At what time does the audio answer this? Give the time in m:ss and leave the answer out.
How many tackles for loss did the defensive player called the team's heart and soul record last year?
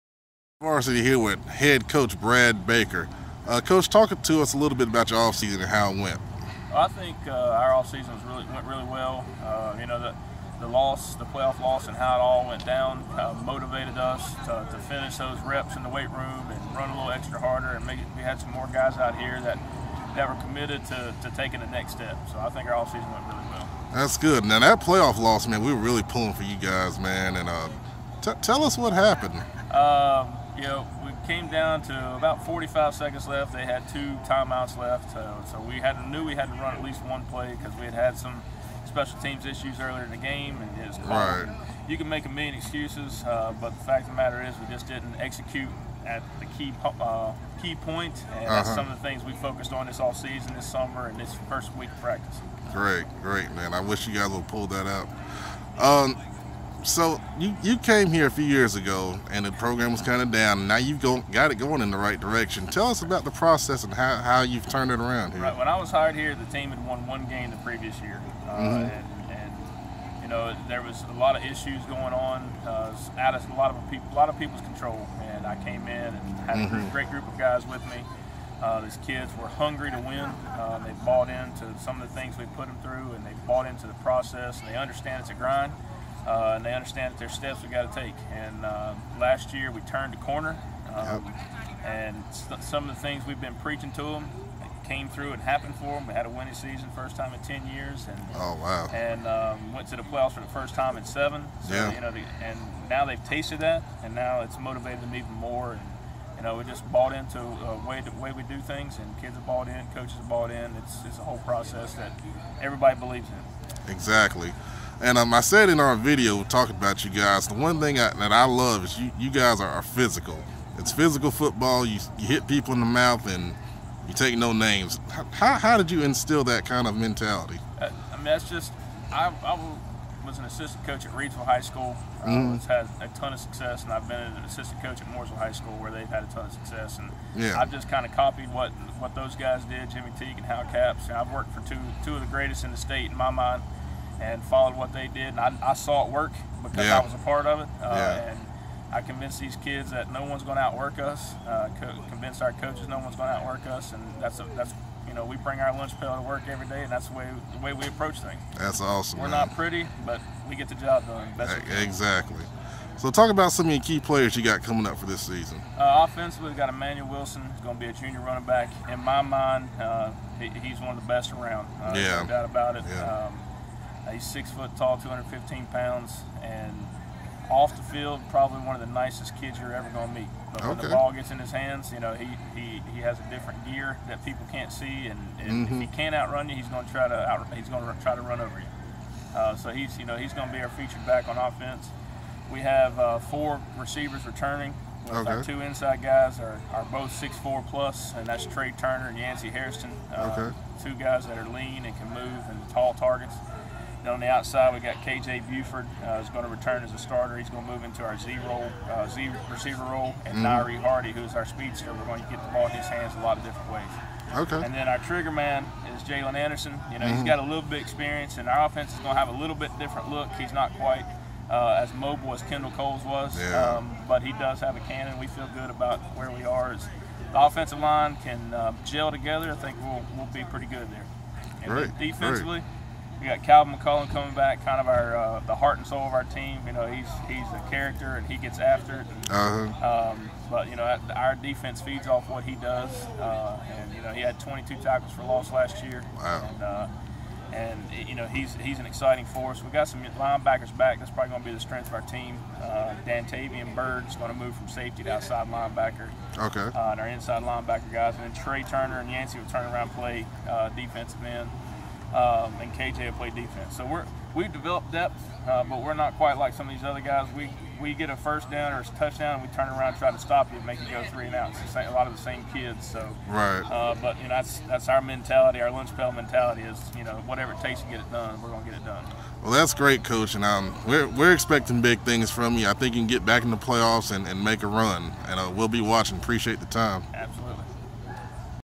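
4:04.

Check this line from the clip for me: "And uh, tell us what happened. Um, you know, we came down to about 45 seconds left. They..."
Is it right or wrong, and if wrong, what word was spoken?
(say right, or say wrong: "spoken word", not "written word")
right.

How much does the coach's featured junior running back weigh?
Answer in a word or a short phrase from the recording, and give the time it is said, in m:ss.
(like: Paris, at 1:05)
215 pounds, at 2:54.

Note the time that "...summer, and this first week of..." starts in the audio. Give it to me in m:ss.
0:50.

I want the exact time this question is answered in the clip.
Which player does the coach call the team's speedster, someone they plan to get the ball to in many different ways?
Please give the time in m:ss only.
3:30.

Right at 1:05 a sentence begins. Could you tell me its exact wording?
right when i was hired here the team had won one game the previous year uh, mm-hmm.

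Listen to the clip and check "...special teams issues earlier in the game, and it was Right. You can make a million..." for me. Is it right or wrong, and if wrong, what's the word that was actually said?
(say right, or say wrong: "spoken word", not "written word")
right.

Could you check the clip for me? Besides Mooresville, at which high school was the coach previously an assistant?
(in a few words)
Reidsville High School.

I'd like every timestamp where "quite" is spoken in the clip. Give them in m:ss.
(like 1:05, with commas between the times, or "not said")
3:40, 4:26.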